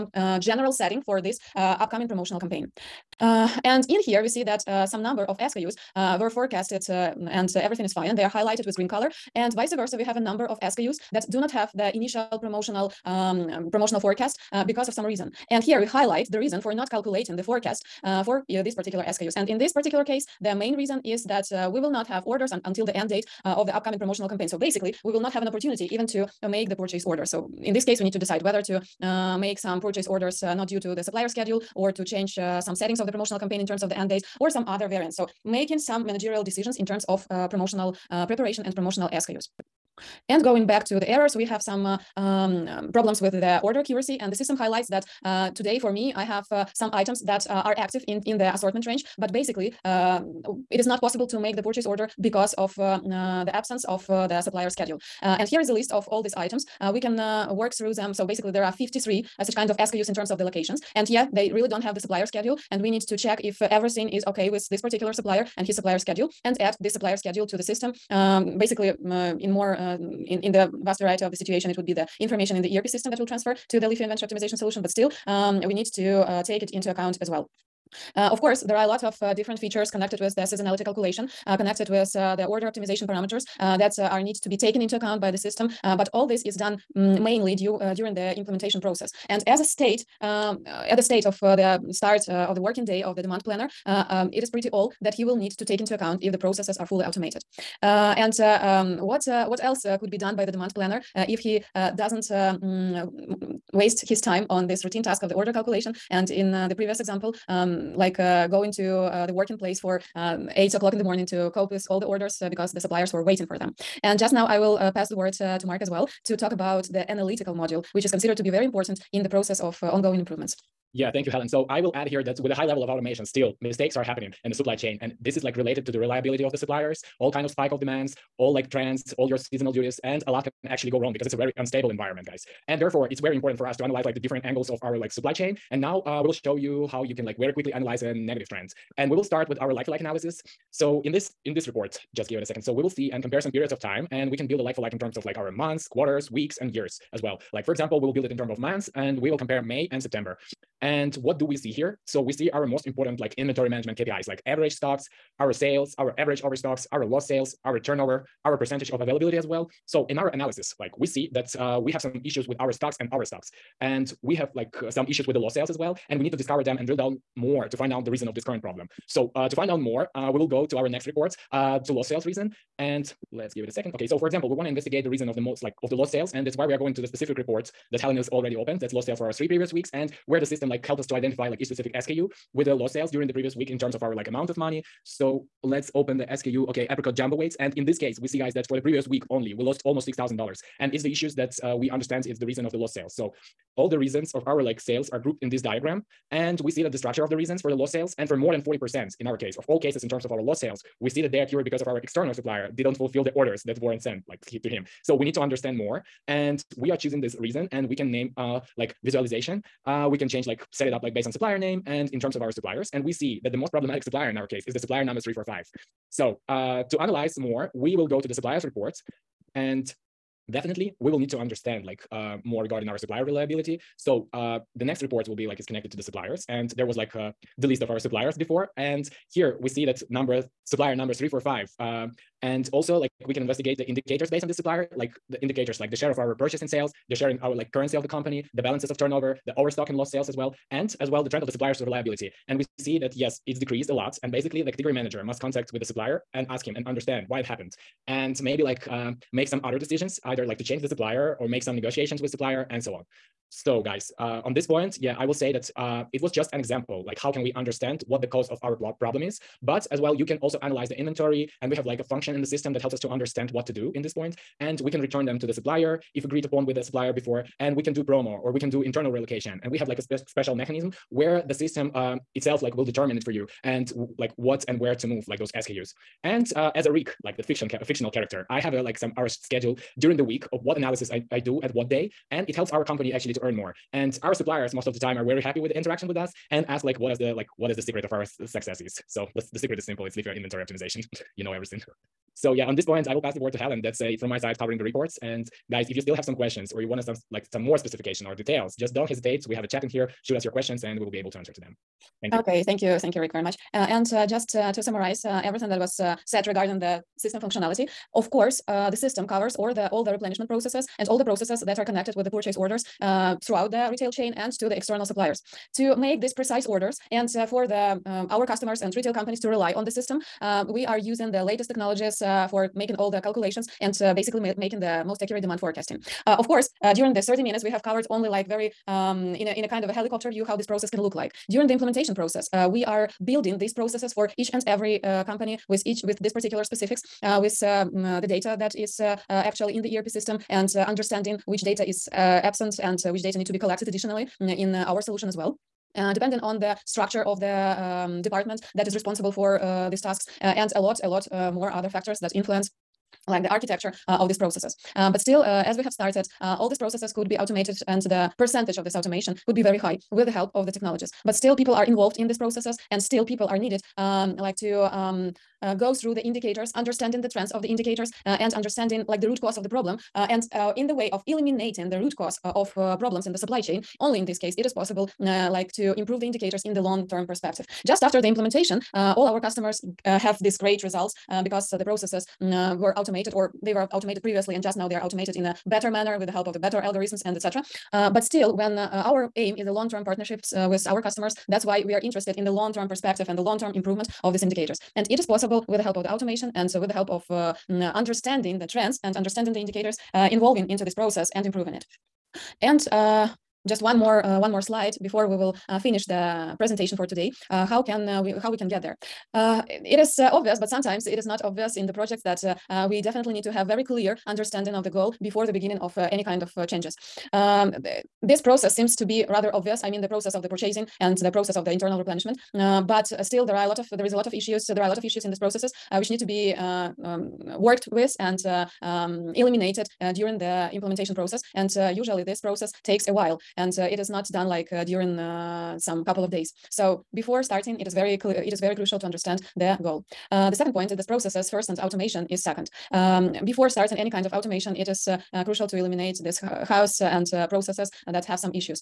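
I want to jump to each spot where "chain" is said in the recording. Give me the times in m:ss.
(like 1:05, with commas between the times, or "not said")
2:04, 2:15, 5:14, 6:13.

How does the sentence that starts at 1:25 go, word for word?
but all this is done Mm, mainly due, uh, during the implementation process.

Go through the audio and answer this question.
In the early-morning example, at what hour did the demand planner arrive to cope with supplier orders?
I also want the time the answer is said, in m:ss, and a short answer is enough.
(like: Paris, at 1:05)
8 o'clock, at 1:50.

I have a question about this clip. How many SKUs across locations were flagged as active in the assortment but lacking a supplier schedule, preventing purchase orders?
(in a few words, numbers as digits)
53.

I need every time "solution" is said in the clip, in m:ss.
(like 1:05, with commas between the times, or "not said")
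1:14, 5:45.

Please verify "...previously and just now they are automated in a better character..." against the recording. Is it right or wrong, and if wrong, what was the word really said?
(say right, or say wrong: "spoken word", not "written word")
wrong: "manner", not "character".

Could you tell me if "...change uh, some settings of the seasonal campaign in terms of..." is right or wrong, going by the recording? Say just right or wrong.
wrong.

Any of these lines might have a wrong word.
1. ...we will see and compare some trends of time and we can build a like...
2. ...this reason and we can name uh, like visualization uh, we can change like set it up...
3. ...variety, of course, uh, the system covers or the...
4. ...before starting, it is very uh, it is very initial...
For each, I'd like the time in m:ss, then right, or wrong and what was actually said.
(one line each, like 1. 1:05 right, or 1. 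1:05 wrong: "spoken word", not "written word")
1. 2:22 wrong: "periods", not "trends"
2. 3:27 right
3. 5:07 wrong: "functionality", not "variety"
4. 7:17 wrong: "crucial", not "initial".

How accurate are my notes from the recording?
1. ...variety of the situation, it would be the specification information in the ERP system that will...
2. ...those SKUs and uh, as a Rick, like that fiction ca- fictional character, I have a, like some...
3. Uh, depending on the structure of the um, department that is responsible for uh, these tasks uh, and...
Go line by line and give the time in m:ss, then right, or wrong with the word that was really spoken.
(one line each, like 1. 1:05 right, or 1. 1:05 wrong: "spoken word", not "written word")
1. 1:10 wrong: "information", not "specification"
2. 4:35 right
3. 5:45 right.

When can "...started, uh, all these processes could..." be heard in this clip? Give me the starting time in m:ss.
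5:55.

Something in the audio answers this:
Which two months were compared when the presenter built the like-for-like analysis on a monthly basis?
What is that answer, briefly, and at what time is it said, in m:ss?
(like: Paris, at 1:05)
May and September, at 2:29.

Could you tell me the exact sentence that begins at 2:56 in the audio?
And that's why we are going to the specific report that Helen is already opened.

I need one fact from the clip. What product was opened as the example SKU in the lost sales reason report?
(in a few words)
apricot jumbo weights.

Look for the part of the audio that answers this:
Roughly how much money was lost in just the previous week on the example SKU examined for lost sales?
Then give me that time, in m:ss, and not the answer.
3:10.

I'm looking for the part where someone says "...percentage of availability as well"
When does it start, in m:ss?
2:38.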